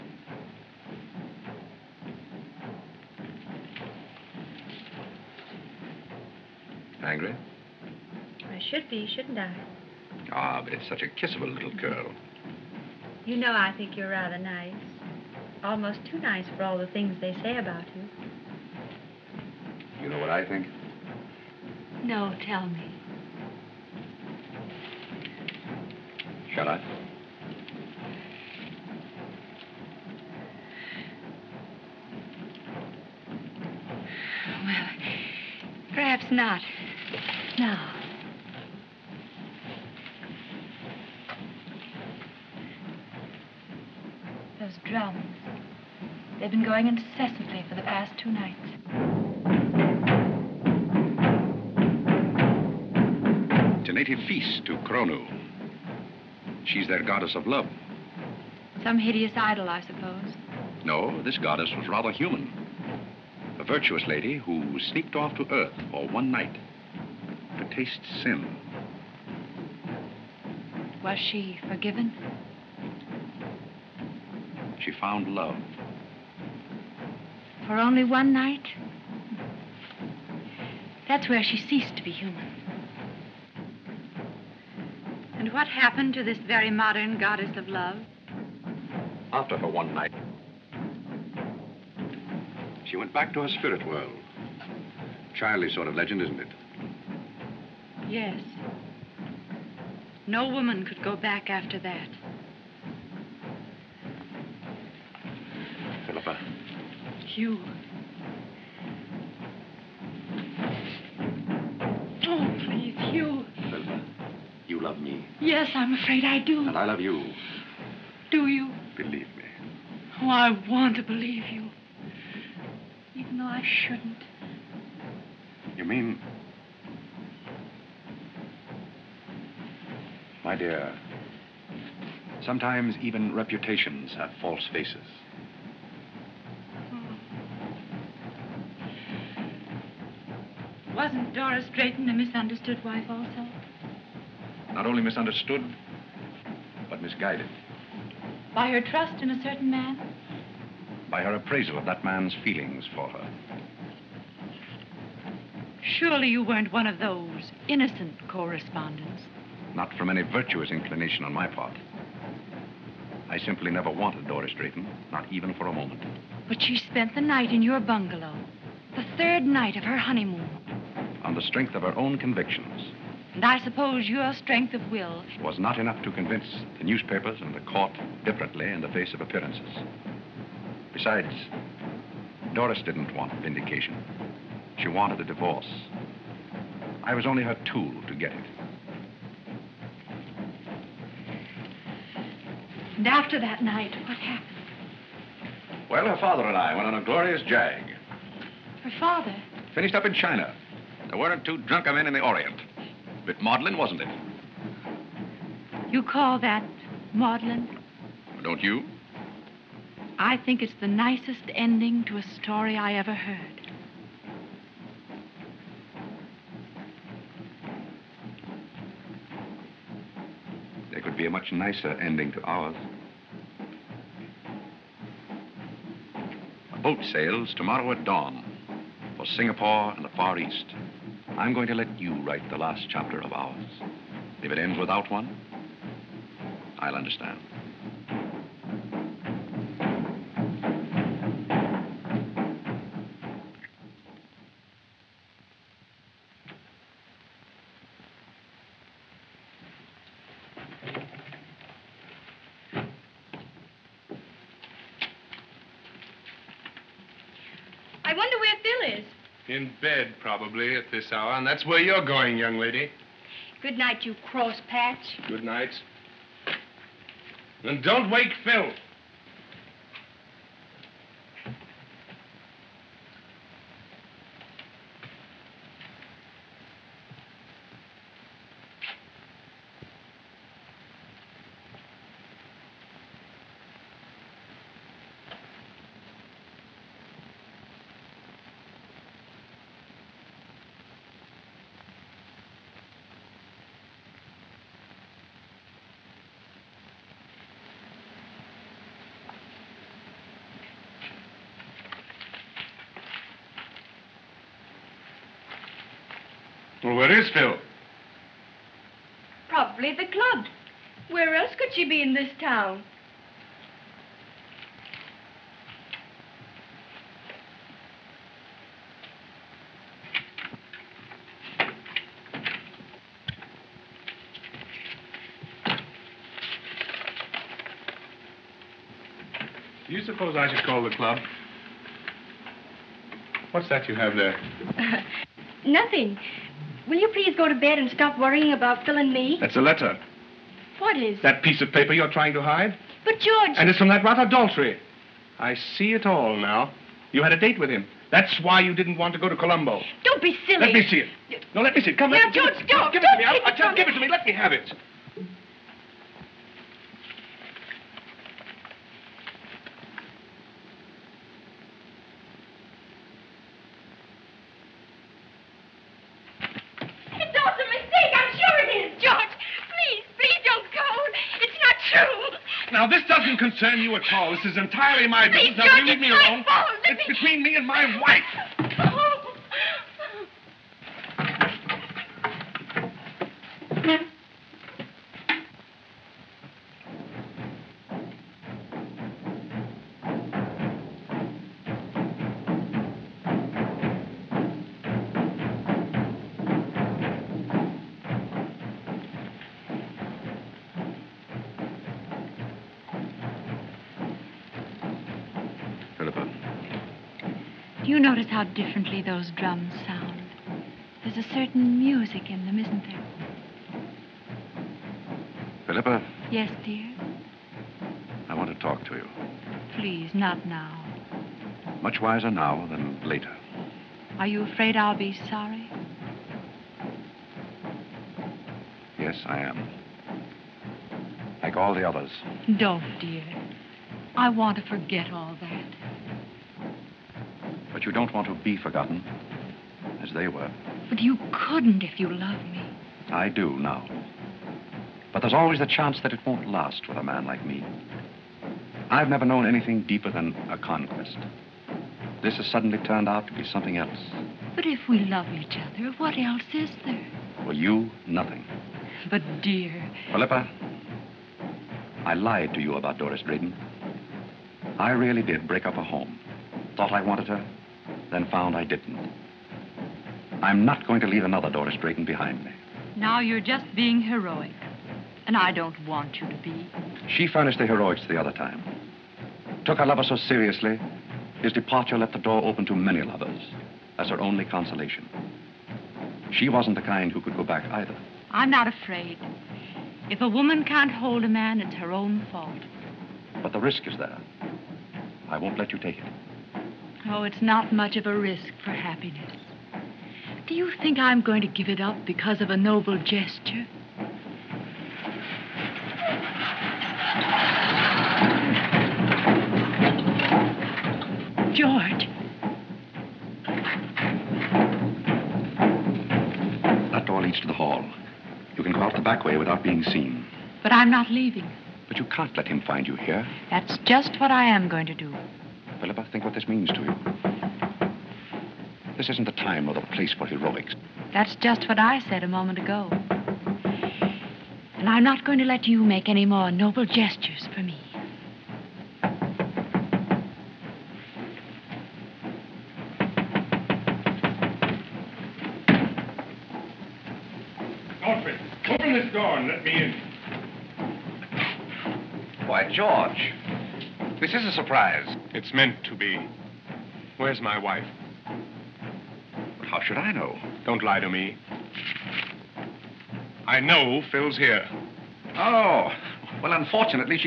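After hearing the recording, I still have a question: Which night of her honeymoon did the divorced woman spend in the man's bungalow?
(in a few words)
The third.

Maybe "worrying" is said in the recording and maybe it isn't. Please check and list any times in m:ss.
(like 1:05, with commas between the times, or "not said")
5:38.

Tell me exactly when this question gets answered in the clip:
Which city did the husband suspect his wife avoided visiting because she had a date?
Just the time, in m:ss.
5:49.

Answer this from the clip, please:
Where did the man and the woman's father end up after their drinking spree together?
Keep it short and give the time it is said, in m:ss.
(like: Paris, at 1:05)
China, at 3:20.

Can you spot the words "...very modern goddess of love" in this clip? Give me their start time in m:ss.
1:26.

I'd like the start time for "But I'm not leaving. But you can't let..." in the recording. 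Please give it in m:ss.
8:40.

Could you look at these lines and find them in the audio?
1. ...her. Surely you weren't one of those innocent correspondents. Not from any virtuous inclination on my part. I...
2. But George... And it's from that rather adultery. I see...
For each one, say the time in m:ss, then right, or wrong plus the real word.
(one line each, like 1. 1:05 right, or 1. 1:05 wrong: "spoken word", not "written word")
1. 2:33 right
2. 5:43 right.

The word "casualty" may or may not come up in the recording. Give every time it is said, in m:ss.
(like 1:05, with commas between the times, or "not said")
not said.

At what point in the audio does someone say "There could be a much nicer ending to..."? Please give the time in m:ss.
3:40.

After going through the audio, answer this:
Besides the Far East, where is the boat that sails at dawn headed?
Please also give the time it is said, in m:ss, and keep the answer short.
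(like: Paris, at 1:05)
Singapore, at 3:49.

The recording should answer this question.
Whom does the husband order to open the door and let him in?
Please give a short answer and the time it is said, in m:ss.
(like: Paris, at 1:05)
Alfred, at 9:08.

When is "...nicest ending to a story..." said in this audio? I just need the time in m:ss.
3:30.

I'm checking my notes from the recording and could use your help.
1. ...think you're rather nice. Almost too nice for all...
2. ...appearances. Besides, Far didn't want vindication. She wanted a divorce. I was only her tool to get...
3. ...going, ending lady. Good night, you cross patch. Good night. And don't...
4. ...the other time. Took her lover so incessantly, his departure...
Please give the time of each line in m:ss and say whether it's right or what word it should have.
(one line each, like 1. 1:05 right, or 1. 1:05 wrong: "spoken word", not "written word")
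1. 0:13 right
2. 2:59 wrong: "Doris", not "Far"
3. 4:22 wrong: "young", not "ending"
4. 7:58 wrong: "seriously", not "incessantly".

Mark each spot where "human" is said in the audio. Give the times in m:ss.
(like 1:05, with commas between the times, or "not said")
1:02, 1:22.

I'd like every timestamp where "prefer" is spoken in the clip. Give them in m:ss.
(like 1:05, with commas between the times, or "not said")
not said.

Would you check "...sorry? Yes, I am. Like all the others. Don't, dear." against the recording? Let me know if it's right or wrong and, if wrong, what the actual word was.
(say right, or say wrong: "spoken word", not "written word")
right.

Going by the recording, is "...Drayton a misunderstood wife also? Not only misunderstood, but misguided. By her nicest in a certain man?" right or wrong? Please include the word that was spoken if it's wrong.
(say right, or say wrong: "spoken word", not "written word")
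wrong: "trust", not "nicest".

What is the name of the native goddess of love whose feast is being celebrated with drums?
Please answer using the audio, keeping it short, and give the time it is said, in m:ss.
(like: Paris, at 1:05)
Kronu, at 0:54.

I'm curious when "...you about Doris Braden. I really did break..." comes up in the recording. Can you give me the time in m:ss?
7:42.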